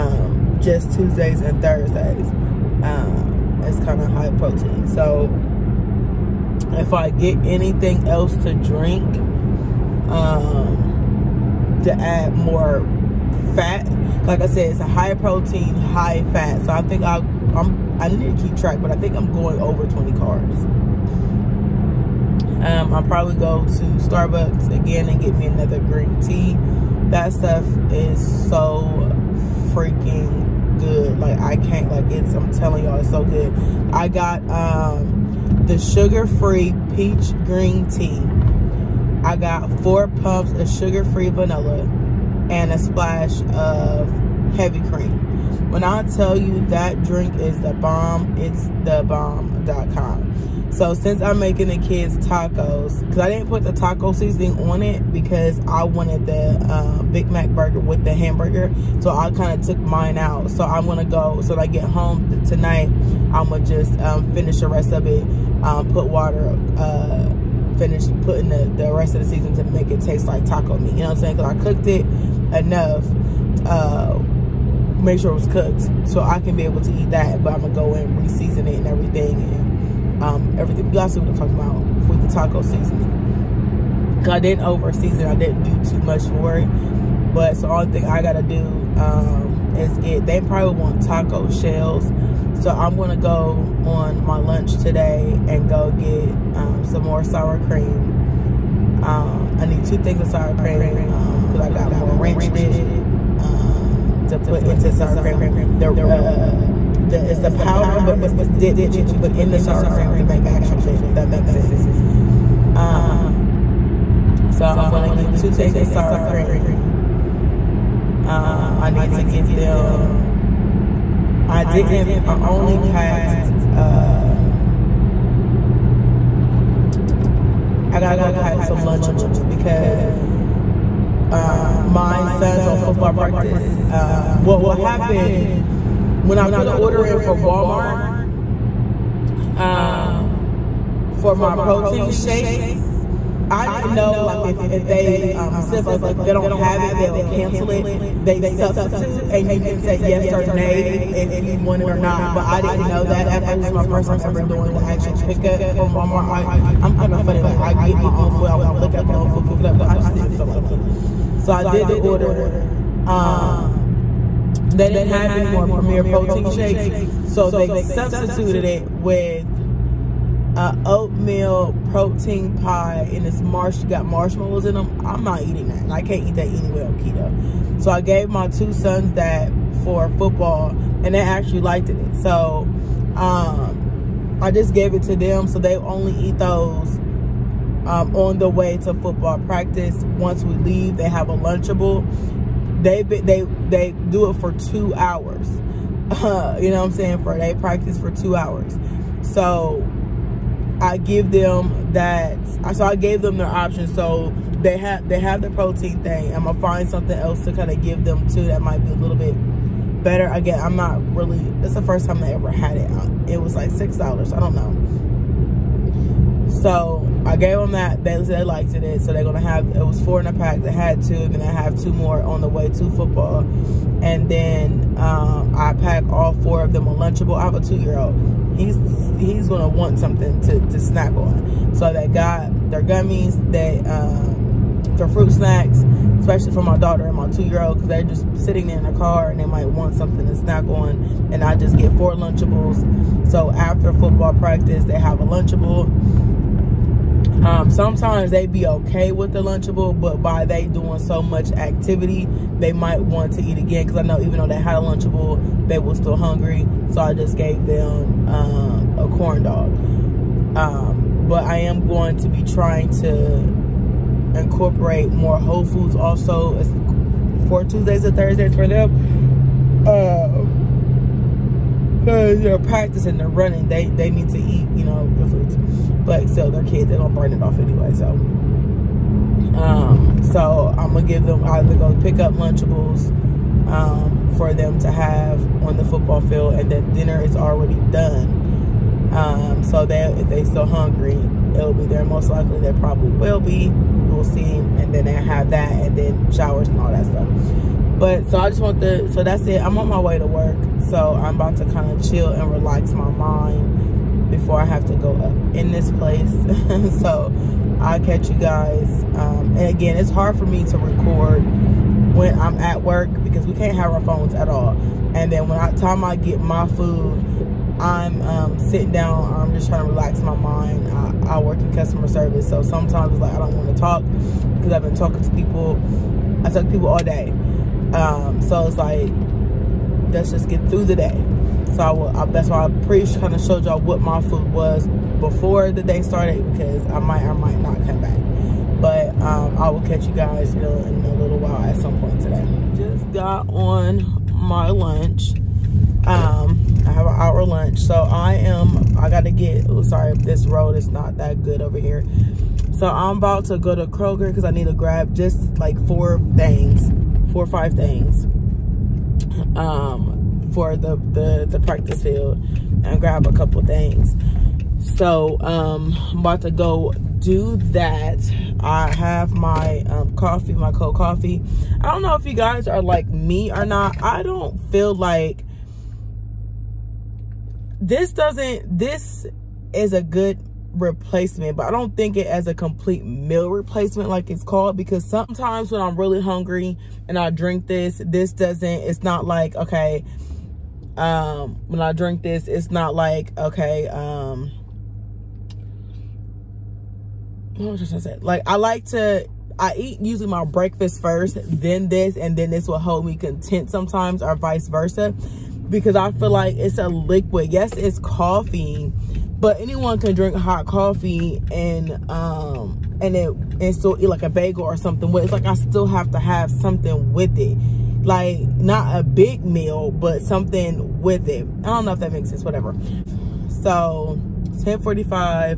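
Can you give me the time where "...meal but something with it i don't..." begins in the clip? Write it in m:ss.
6:59.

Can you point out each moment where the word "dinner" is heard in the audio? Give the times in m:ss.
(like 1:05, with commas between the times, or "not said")
4:46.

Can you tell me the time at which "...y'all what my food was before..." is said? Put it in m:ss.
5:33.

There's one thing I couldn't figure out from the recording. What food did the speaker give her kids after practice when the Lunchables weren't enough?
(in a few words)
corn dog.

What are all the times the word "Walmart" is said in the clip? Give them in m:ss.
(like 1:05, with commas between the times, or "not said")
2:17, 2:35.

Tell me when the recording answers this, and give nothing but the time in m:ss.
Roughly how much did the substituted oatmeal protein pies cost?
3:33.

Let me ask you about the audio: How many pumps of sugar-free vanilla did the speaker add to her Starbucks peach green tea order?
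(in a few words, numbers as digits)
4.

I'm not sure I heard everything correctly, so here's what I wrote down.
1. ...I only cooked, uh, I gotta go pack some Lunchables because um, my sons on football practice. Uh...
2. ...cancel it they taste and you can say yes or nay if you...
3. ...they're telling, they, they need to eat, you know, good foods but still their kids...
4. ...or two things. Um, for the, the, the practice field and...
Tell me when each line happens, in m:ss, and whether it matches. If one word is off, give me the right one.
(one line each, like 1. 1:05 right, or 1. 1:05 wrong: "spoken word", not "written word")
1. 2:02 wrong: "packed", not "cooked"
2. 2:27 wrong: "substitute", not "taste"
3. 4:33 wrong: "running", not "telling"
4. 5:57 wrong: "five", not "two".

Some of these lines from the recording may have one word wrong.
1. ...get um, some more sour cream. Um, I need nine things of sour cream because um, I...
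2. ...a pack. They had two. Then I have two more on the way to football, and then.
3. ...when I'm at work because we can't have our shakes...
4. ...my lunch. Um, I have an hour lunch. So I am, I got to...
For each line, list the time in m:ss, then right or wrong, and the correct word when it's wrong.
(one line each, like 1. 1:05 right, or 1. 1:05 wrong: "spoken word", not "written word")
1. 1:35 wrong: "two", not "nine"
2. 3:40 right
3. 5:12 wrong: "phones", not "shakes"
4. 5:44 right.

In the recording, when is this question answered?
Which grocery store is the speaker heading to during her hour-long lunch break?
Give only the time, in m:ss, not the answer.
5:53.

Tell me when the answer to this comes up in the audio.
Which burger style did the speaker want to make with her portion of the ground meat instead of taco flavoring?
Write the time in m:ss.
0:57.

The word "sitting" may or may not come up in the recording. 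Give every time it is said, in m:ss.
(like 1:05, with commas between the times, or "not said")
3:58, 5:18.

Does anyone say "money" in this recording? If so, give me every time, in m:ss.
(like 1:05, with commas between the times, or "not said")
not said.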